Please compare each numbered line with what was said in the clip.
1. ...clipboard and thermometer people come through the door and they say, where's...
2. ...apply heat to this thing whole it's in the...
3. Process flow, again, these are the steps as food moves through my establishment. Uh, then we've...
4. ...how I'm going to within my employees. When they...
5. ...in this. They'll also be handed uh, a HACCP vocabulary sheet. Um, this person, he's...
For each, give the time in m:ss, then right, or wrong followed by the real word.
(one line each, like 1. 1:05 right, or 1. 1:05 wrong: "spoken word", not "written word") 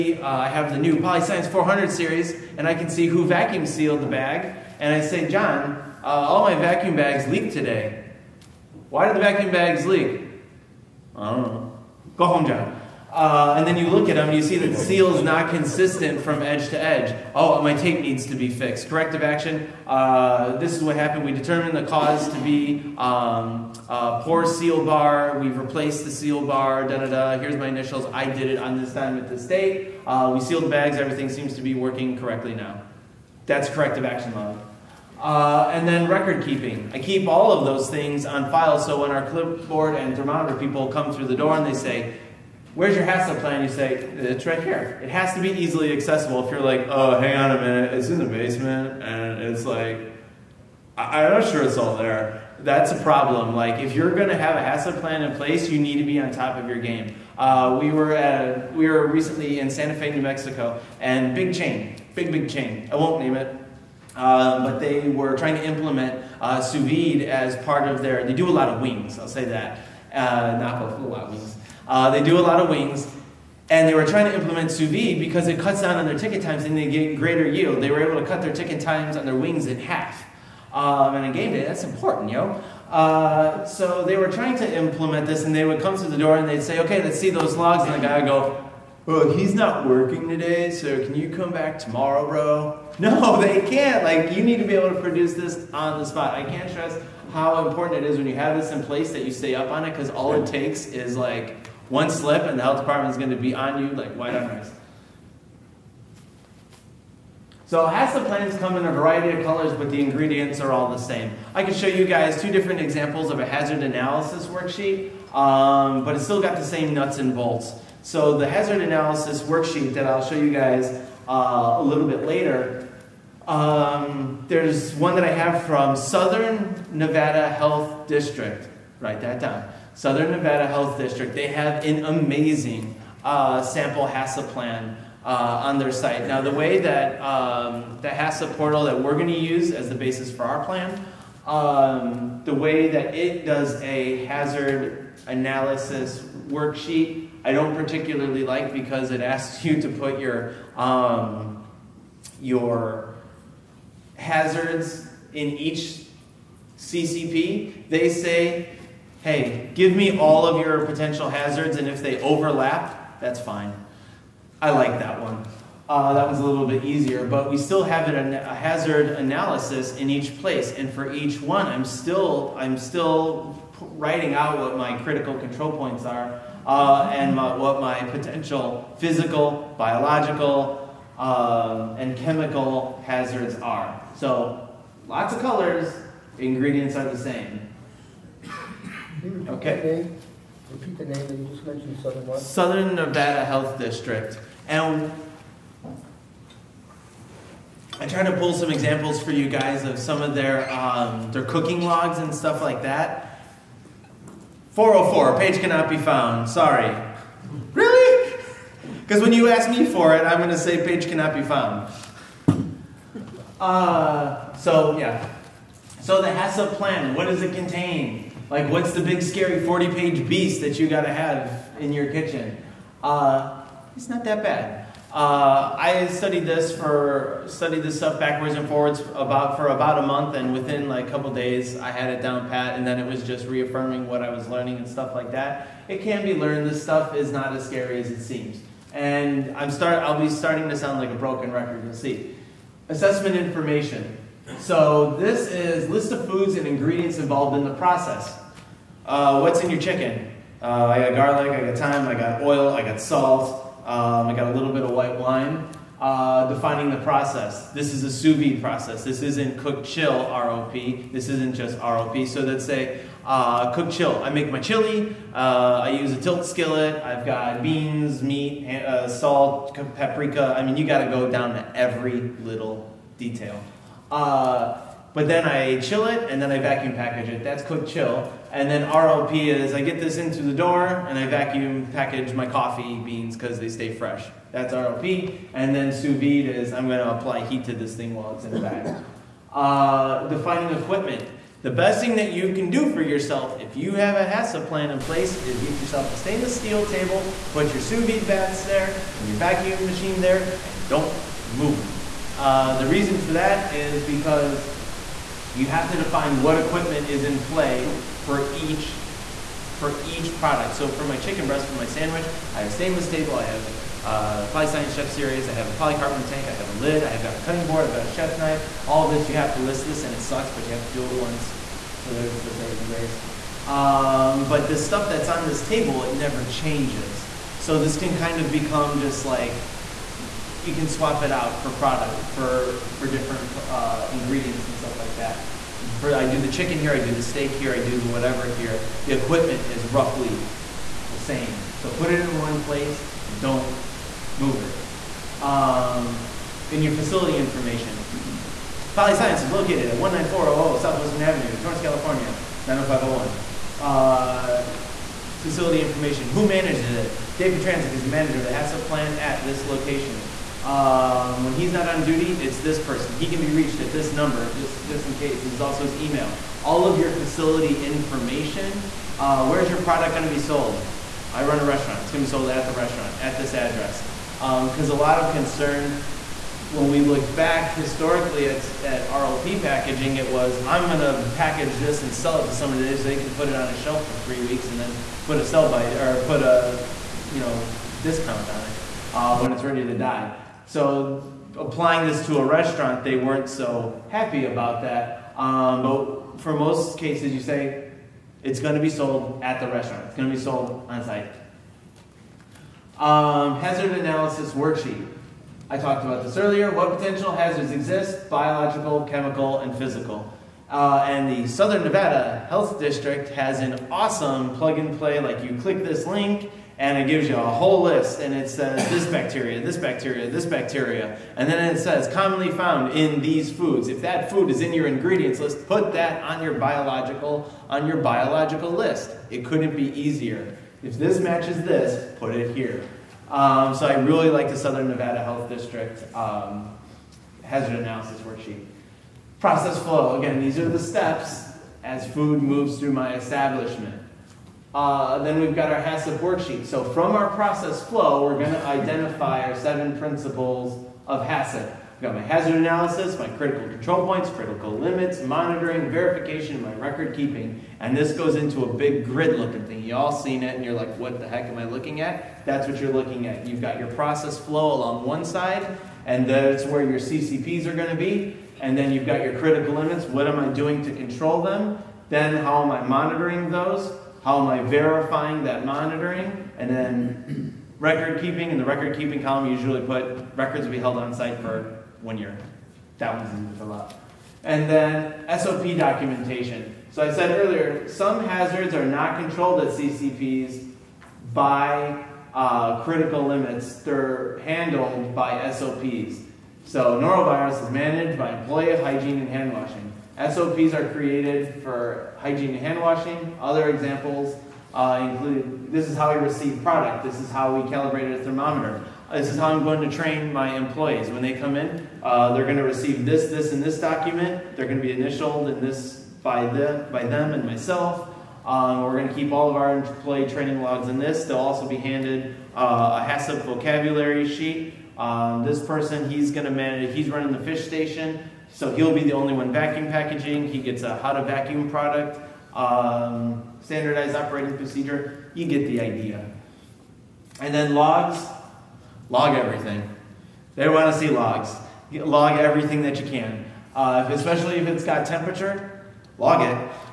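1. 0:39 right
2. 4:47 wrong: "while", not "whole"
3. 7:19 right
4. 8:29 wrong: "train", not "within"
5. 8:40 right.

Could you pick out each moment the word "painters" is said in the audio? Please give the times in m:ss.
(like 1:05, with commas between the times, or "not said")
not said.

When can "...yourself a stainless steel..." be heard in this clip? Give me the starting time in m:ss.
4:55.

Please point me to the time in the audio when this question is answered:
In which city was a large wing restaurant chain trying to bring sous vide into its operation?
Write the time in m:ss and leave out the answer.
0:59.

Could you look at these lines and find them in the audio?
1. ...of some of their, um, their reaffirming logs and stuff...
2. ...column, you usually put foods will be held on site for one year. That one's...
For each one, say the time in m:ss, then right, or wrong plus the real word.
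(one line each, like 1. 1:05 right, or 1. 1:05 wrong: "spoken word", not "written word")
1. 3:19 wrong: "cooking", not "reaffirming"
2. 7:59 wrong: "records", not "foods".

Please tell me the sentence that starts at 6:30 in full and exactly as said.
So applying this to a restaurant, they weren't so happy about that.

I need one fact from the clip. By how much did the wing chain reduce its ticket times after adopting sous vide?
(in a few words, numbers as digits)
In half.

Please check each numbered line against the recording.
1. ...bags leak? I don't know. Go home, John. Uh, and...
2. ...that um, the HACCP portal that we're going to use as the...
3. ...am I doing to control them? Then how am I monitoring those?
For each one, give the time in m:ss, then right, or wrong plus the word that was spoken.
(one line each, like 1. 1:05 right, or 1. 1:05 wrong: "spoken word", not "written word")
1. 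0:09 right
2. 2:16 right
3. 7:50 right.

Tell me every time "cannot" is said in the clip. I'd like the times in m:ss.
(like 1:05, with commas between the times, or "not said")
3:25, 3:31.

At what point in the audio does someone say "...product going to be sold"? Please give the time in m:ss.
6:09.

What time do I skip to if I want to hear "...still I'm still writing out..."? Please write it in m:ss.
2:51.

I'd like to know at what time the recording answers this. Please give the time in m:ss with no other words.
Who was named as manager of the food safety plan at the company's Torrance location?
5:57.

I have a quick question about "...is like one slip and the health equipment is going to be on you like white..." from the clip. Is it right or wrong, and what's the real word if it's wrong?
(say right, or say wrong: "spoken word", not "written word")
wrong: "department", not "equipment".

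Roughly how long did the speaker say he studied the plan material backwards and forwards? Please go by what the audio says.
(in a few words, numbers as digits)
About a month.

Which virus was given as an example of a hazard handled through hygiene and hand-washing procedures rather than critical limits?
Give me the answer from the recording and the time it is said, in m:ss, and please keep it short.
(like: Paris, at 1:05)
Norovirus, at 8:17.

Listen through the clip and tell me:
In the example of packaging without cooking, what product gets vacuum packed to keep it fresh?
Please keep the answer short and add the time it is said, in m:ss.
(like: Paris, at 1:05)
Coffee beans, at 4:42.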